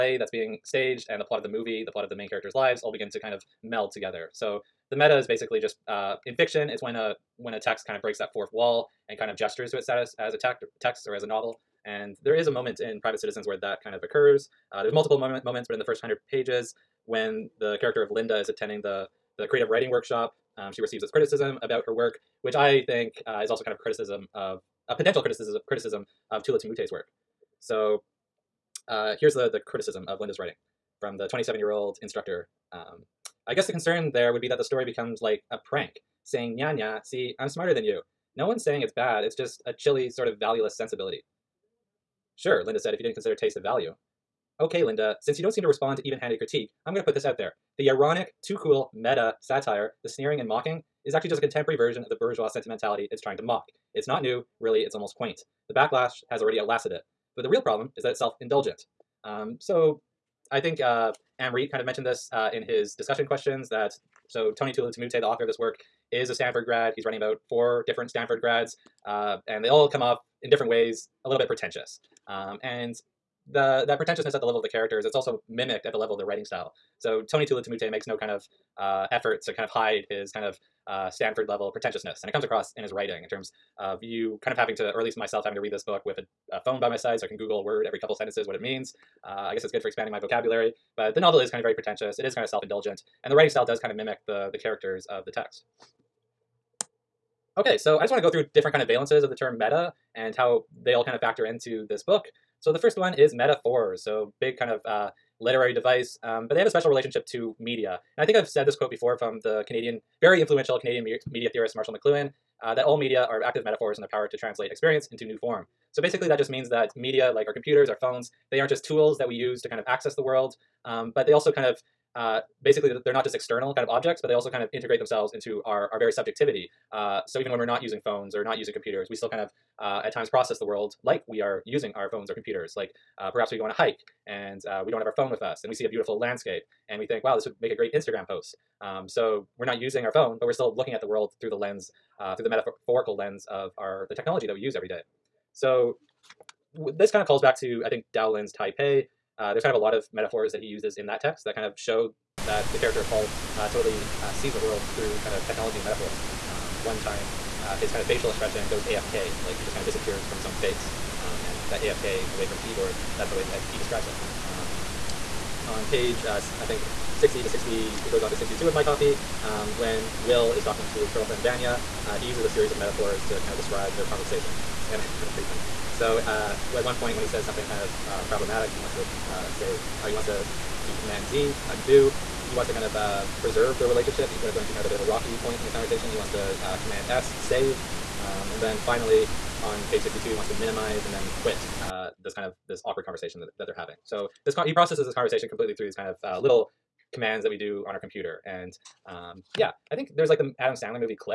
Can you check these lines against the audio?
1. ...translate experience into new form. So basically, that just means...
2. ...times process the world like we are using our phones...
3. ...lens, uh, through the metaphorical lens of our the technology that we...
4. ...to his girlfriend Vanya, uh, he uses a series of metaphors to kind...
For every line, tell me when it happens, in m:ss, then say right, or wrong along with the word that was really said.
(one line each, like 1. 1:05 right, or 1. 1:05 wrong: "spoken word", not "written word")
1. 1:54 right
2. 2:10 right
3. 2:21 right
4. 2:50 right.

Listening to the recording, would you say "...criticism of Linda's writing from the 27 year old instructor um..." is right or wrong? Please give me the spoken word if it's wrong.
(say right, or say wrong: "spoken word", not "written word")
right.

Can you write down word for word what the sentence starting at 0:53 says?
It's not new, really, it's almost quaint.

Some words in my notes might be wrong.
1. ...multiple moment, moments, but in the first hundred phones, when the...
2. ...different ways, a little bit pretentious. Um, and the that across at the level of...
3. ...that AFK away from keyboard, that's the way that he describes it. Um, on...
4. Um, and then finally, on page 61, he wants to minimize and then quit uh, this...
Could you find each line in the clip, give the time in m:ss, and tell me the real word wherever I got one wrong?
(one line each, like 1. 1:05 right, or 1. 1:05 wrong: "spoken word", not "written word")
1. 0:14 wrong: "pages", not "phones"
2. 1:10 wrong: "pretentiousness", not "across"
3. 2:41 right
4. 3:08 wrong: "62", not "61".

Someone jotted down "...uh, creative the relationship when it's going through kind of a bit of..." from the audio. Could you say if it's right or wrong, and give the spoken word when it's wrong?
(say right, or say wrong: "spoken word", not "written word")
wrong: "preserve", not "creative".